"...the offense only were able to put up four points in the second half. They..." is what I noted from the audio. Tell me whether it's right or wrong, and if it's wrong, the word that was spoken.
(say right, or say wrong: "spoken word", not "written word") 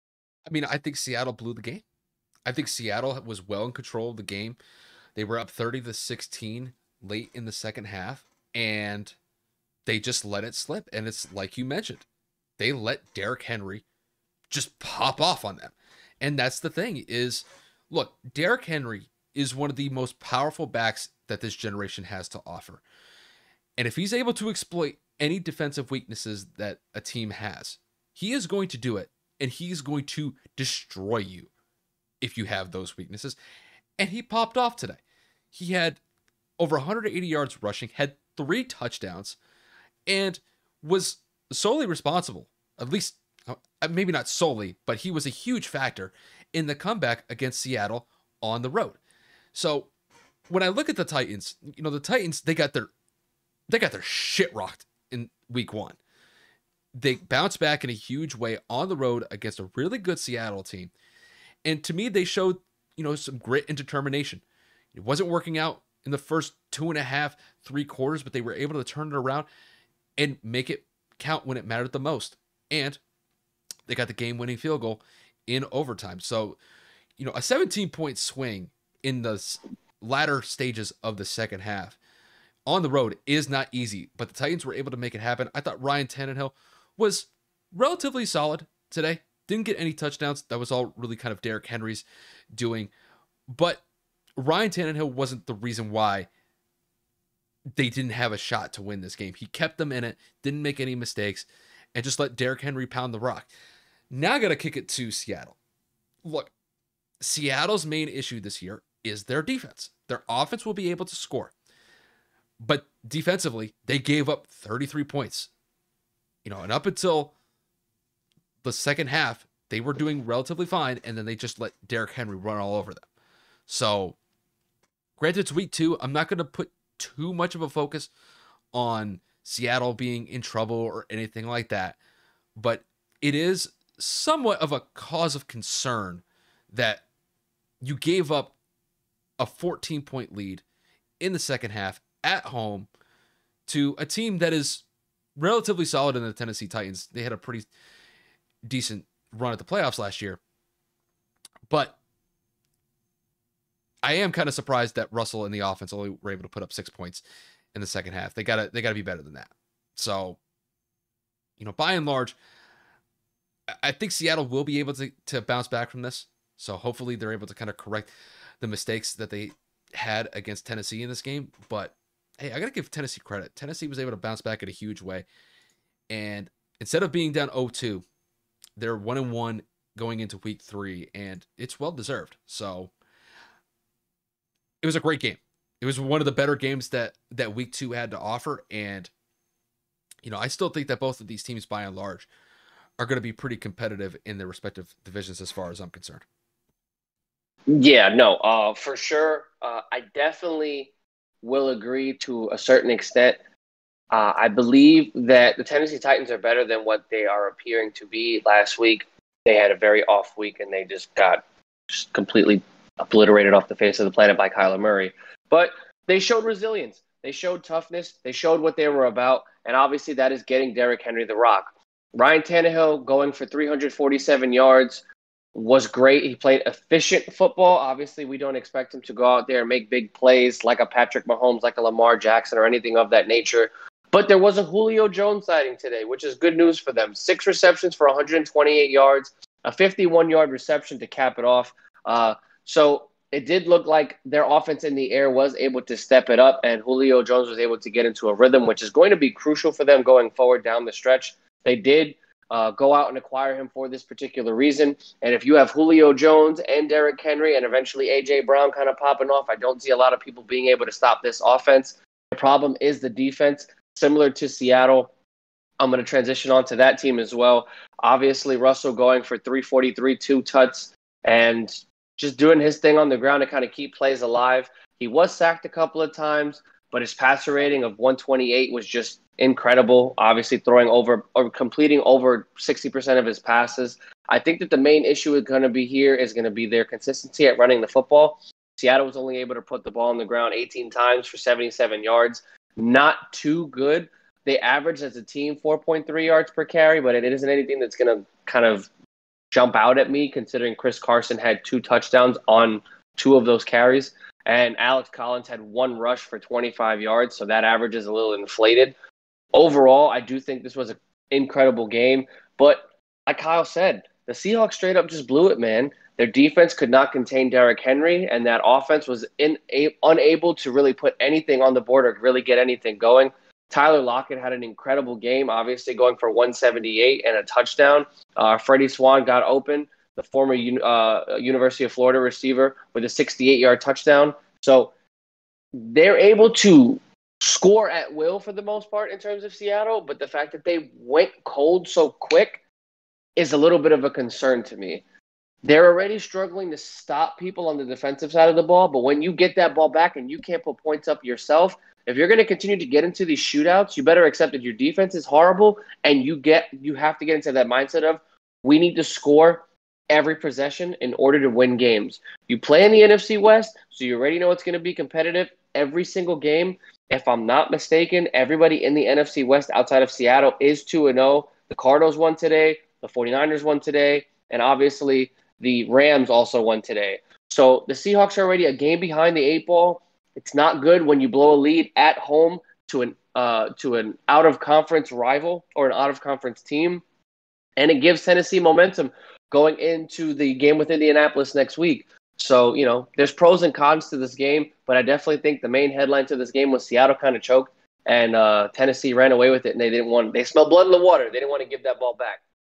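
wrong: "six", not "four".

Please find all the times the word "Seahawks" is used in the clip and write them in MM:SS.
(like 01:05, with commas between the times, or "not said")
05:14, 06:17.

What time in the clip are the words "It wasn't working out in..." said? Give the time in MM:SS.
01:04.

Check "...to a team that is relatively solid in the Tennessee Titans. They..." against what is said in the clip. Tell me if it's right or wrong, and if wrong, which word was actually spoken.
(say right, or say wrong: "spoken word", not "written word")
right.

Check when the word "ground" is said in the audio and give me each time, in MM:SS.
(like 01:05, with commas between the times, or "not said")
04:33, 04:50.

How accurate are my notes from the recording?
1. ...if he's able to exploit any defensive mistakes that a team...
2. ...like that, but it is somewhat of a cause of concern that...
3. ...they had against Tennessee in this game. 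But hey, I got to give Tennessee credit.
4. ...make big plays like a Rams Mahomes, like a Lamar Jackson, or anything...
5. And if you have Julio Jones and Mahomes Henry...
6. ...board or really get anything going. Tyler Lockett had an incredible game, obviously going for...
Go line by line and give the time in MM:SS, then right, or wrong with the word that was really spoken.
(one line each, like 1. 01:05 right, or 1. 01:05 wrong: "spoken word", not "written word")
1. 00:23 wrong: "weaknesses", not "mistakes"
2. 02:11 right
3. 02:49 right
4. 03:49 wrong: "Patrick", not "Rams"
5. 04:15 wrong: "Derrick", not "Mahomes"
6. 05:21 right.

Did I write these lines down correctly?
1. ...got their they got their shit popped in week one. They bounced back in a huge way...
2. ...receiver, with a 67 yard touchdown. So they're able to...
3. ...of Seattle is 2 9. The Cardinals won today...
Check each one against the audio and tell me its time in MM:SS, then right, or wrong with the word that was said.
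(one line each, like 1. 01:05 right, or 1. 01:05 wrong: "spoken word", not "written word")
1. 00:52 wrong: "rocked", not "popped"
2. 05:32 wrong: "68", not "67"
3. 06:10 wrong: "0", not "9".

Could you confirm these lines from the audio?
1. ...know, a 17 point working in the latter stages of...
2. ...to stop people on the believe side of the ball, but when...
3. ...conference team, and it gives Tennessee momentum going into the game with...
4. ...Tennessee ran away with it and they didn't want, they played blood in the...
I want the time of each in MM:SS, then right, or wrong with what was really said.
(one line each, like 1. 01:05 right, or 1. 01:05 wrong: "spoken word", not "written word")
1. 01:17 wrong: "swing", not "working"
2. 05:46 wrong: "defensive", not "believe"
3. 06:26 right
4. 06:38 wrong: "smelled", not "played".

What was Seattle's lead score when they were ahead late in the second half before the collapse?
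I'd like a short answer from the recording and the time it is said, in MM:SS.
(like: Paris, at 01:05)
30 to 16, at 00:05.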